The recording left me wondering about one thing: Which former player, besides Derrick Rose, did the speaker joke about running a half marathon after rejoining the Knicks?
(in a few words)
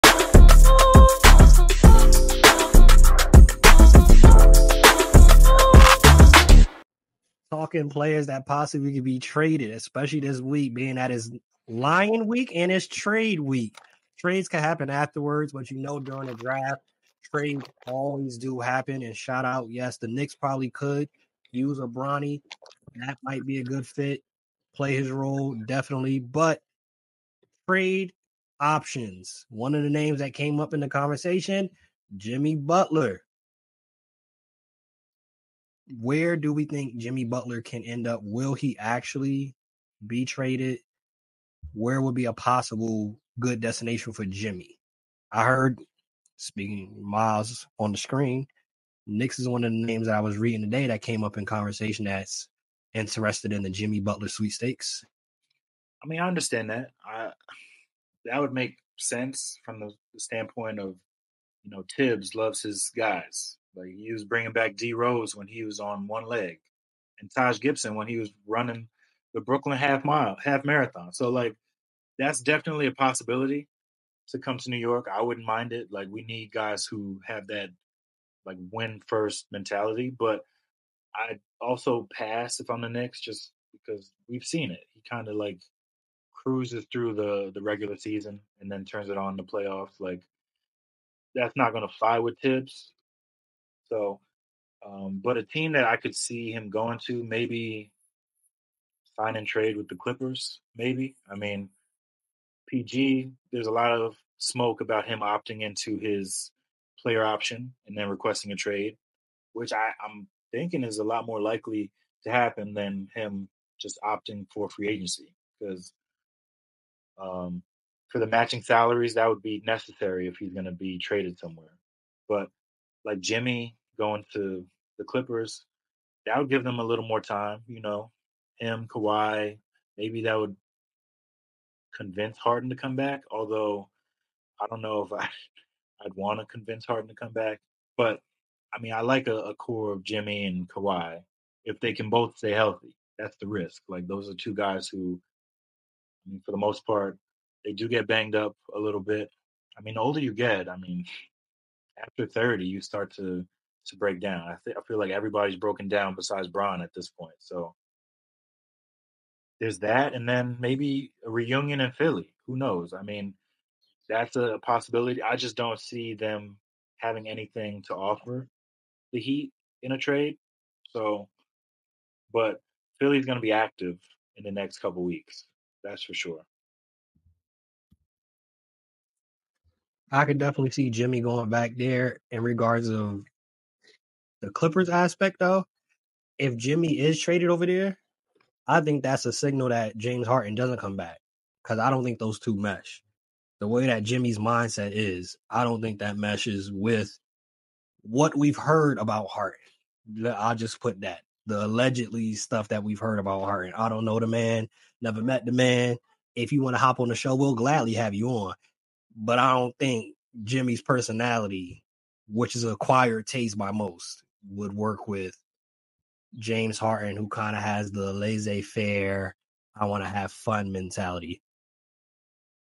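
Taj Gibson.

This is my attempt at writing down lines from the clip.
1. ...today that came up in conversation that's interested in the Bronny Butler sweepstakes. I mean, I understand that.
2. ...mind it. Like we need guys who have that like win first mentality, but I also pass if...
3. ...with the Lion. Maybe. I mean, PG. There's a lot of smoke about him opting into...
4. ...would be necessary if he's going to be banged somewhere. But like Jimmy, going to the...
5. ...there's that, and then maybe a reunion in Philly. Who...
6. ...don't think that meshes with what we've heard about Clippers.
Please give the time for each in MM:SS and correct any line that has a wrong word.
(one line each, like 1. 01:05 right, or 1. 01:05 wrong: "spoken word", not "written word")
1. 00:50 wrong: "Jimmy", not "Bronny"
2. 01:15 right
3. 01:39 wrong: "Clippers", not "Lion"
4. 01:59 wrong: "traded", not "banged"
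5. 02:39 right
6. 03:15 wrong: "Harden", not "Clippers".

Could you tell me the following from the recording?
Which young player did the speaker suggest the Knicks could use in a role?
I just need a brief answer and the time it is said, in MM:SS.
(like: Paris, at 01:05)
Bronny, at 00:21.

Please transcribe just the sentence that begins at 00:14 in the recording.
Trades can happen afterwards, but you know during the draft, trades always do happen.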